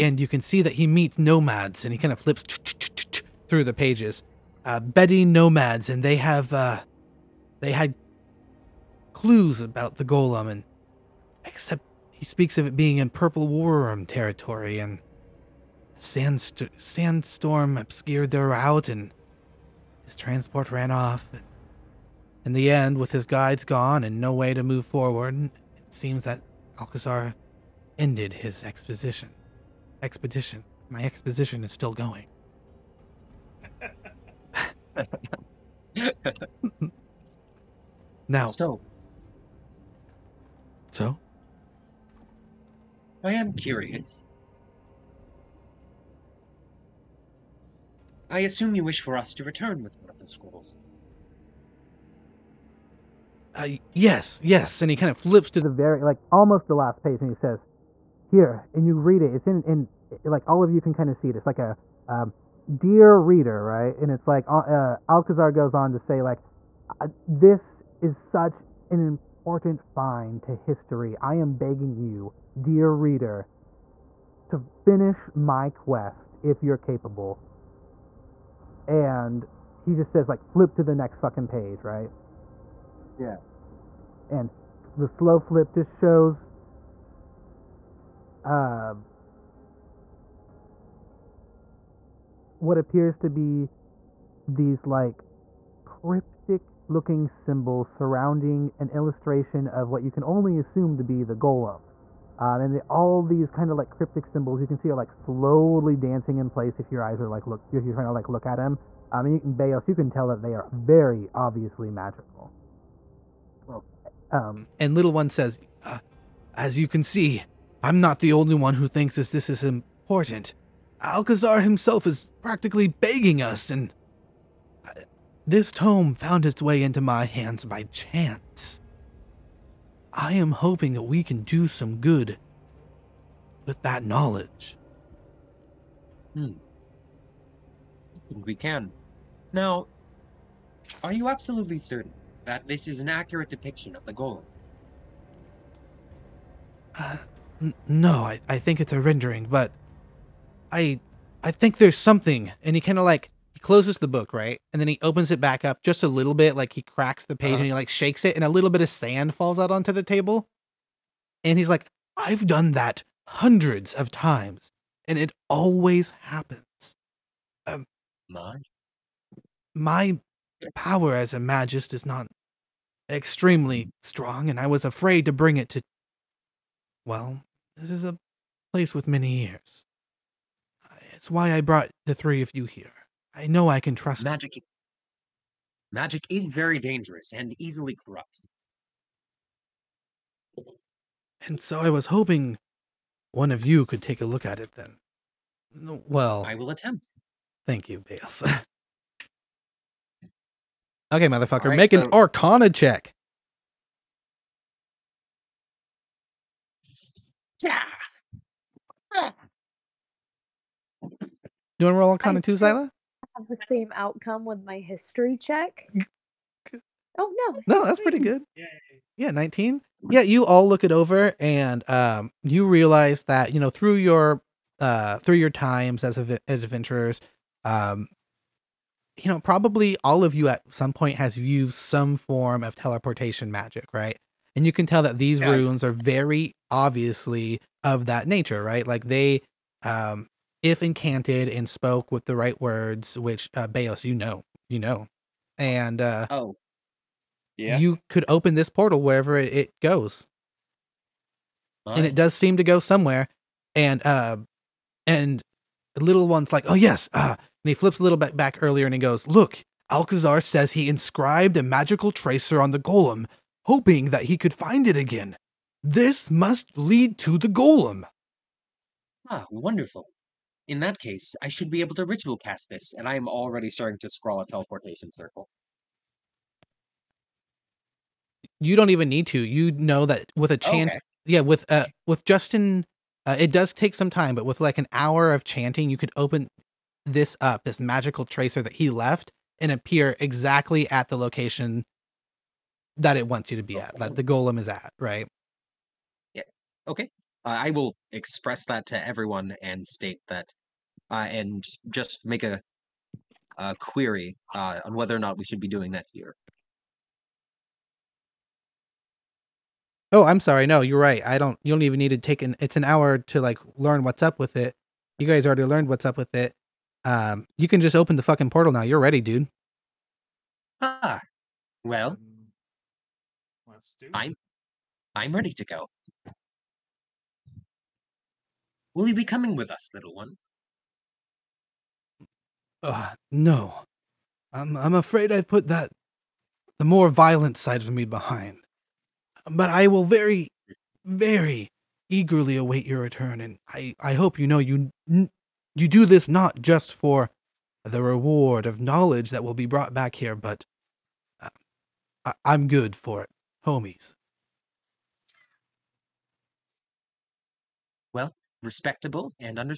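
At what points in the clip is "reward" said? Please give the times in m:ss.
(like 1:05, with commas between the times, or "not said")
5:48.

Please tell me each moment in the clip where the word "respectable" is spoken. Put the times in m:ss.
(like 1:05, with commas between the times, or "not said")
5:58.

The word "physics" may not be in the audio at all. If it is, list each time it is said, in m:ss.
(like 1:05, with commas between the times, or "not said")
not said.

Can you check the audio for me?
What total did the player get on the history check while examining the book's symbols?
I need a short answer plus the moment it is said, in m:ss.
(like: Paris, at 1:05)
19, at 3:39.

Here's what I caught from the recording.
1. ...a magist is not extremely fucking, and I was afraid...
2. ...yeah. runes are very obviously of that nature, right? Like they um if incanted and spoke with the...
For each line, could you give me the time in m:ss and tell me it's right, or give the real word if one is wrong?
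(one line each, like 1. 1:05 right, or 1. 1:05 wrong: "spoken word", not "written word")
1. 2:51 wrong: "strong", not "fucking"
2. 3:55 right.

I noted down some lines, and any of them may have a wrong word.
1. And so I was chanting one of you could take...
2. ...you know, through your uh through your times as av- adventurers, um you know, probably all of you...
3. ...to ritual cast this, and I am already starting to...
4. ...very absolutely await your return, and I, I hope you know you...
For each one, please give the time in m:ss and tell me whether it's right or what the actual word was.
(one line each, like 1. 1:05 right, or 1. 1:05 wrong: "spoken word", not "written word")
1. 3:11 wrong: "hoping", not "chanting"
2. 3:43 right
3. 4:31 right
4. 5:41 wrong: "eagerly", not "absolutely".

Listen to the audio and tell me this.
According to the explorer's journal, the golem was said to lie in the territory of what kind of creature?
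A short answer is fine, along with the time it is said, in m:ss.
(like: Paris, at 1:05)
purple worm, at 0:13.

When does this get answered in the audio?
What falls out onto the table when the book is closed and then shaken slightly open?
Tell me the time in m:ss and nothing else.
2:38.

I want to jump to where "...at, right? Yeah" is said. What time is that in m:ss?
4:54.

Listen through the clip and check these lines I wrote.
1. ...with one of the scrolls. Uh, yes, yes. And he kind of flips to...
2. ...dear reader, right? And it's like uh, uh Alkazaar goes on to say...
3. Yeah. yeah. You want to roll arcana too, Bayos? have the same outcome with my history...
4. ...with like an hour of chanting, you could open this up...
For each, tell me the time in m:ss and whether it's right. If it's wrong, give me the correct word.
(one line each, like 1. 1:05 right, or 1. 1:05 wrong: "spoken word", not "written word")
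1. 0:49 right
2. 1:02 right
3. 3:27 wrong: "Zyla", not "Bayos"
4. 4:44 right.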